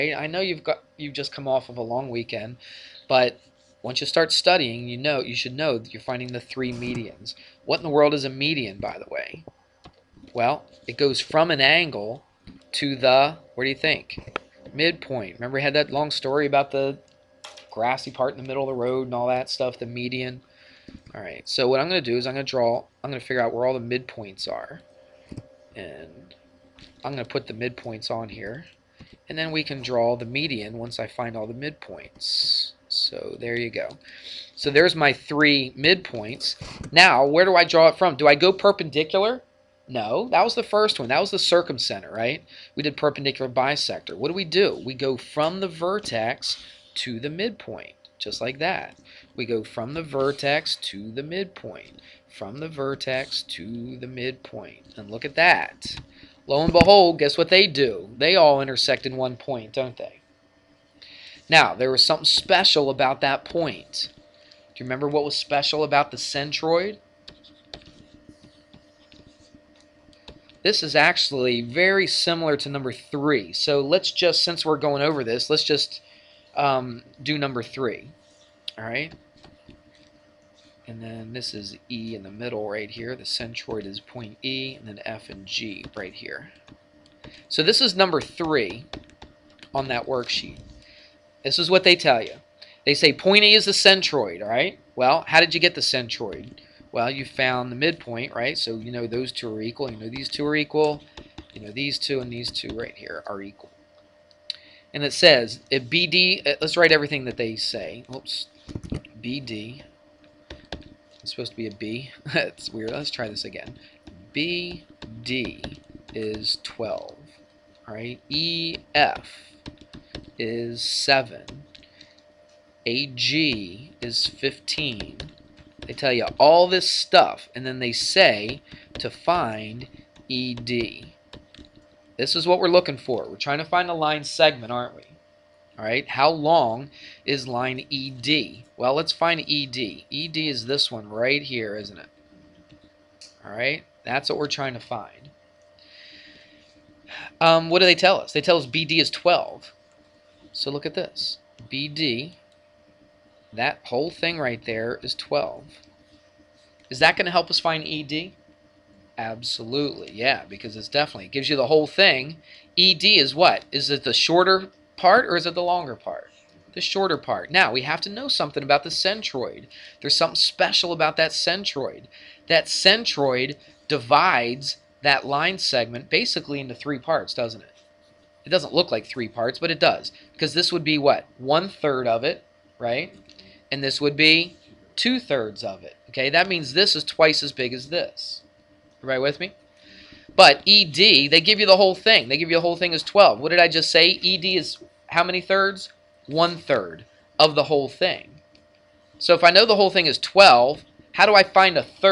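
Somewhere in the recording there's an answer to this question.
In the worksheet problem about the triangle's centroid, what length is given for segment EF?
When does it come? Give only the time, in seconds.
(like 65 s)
118 s.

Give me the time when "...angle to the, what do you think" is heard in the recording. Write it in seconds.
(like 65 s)
11 s.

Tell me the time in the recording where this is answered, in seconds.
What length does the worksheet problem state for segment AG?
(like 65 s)
122 s.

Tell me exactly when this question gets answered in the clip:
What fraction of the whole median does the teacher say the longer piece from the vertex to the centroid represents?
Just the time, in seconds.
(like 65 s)
184 s.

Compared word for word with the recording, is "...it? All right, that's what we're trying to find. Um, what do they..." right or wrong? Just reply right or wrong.
right.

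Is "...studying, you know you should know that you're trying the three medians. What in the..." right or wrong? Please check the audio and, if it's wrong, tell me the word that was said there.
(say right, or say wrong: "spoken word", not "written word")
wrong: "finding", not "trying".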